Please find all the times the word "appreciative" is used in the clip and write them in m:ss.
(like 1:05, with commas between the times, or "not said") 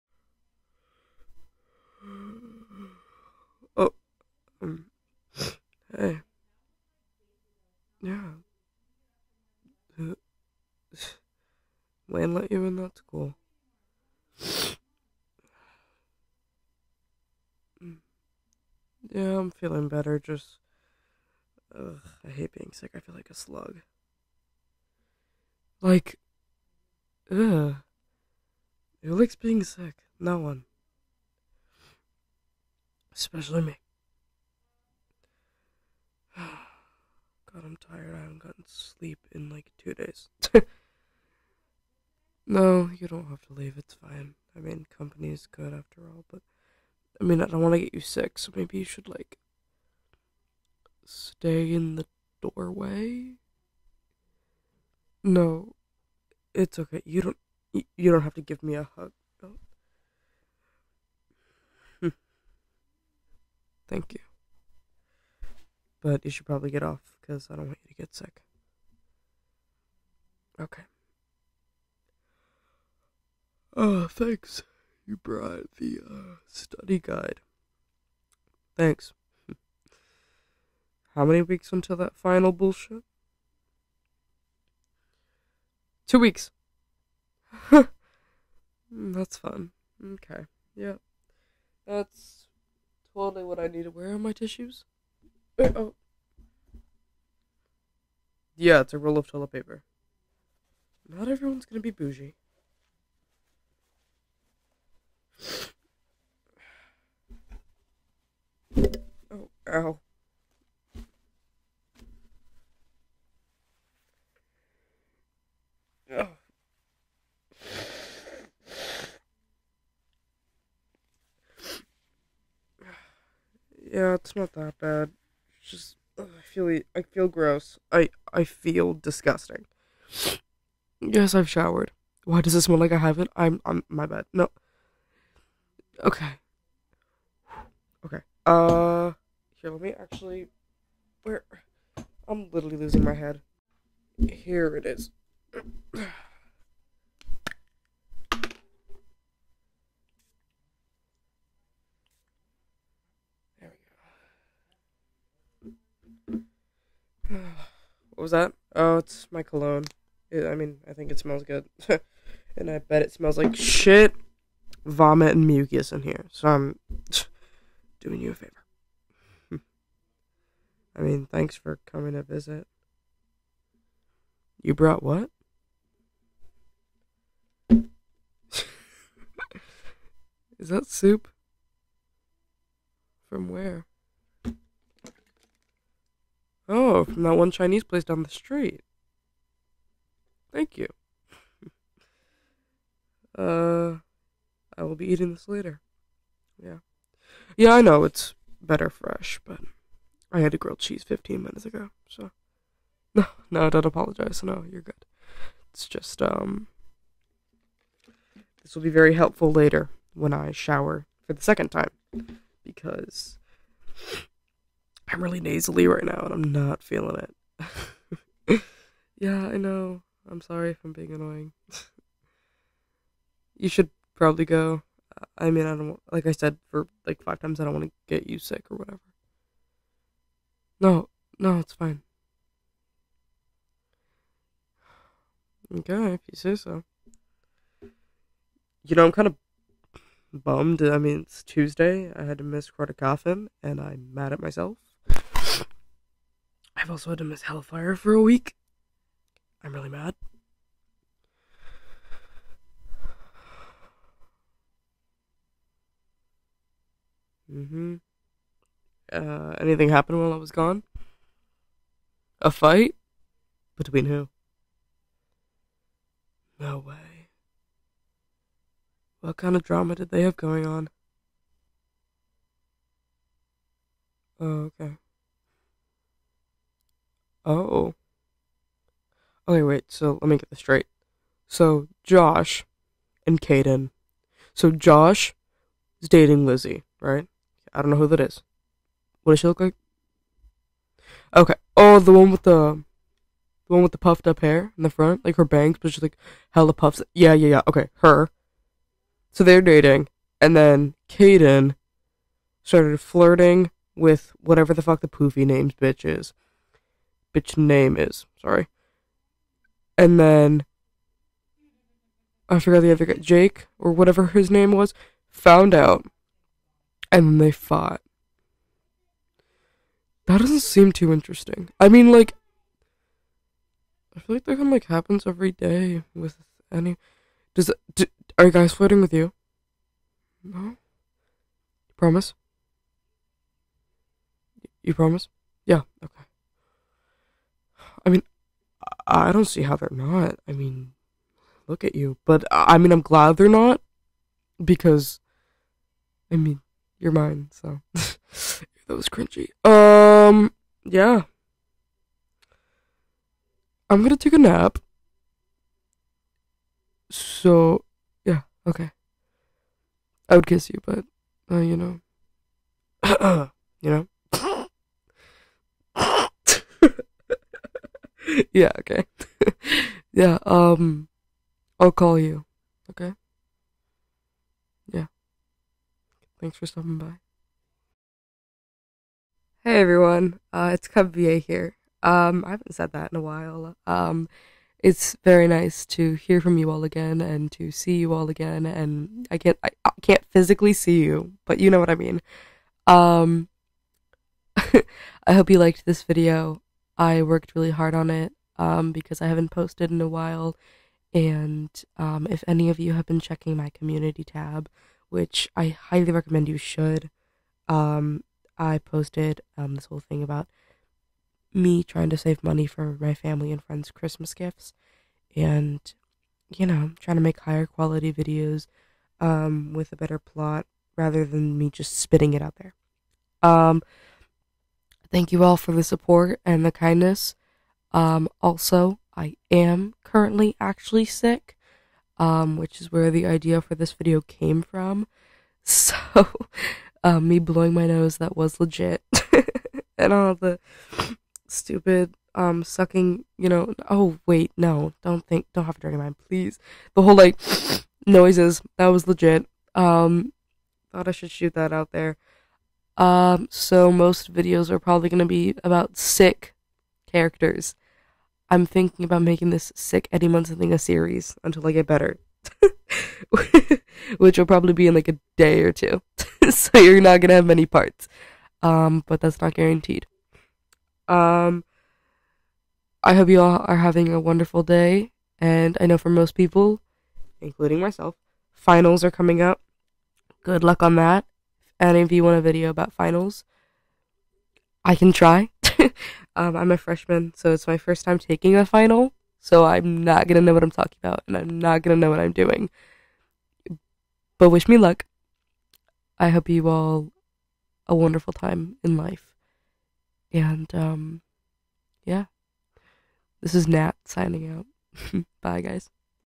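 not said.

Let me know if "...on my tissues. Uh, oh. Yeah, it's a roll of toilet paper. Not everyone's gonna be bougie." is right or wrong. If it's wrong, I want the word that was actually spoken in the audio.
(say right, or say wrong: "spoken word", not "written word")
right.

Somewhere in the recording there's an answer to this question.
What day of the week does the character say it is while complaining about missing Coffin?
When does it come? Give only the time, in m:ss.
4:01.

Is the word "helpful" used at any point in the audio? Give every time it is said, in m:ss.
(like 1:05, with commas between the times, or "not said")
3:29.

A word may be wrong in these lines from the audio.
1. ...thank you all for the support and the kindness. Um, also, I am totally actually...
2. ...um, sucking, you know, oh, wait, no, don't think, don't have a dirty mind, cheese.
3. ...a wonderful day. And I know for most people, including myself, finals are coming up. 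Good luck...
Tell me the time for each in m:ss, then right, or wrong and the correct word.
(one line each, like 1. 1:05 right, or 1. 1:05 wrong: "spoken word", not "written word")
1. 7:05 wrong: "currently", not "totally"
2. 7:22 wrong: "please", not "cheese"
3. 7:54 right.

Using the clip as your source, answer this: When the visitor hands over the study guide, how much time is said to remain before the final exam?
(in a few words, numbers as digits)
2 weeks.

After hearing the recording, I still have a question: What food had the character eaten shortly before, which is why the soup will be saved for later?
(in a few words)
grilled cheese.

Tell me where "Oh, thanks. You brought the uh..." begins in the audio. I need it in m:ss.
1:13.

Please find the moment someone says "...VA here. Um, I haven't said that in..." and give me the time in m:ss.
6:21.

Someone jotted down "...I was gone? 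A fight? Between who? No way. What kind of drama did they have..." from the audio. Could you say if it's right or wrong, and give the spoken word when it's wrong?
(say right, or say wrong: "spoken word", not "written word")
right.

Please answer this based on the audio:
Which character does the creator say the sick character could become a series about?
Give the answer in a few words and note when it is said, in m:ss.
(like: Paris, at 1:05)
Eddie Munson, at 7:40.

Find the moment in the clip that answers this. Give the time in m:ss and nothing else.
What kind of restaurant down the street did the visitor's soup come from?
3:07.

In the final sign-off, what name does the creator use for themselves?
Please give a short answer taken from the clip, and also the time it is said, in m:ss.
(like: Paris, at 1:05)
Nat, at 8:23.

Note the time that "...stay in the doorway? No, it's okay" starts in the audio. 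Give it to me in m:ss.
0:51.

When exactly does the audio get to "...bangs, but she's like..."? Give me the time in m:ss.
4:55.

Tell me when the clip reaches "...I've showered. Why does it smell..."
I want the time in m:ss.
2:11.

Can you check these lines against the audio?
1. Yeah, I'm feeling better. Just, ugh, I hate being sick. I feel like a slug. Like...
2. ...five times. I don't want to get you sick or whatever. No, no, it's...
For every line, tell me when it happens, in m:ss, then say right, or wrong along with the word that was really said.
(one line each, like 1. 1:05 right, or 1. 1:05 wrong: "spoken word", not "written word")
1. 0:19 right
2. 3:47 right.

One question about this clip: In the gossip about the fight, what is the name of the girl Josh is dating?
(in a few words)
Lizzie.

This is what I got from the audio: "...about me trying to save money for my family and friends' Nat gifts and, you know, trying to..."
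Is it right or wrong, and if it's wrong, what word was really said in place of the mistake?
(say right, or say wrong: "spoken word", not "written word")
wrong: "Christmas", not "Nat".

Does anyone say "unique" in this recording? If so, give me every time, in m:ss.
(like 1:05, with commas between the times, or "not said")
not said.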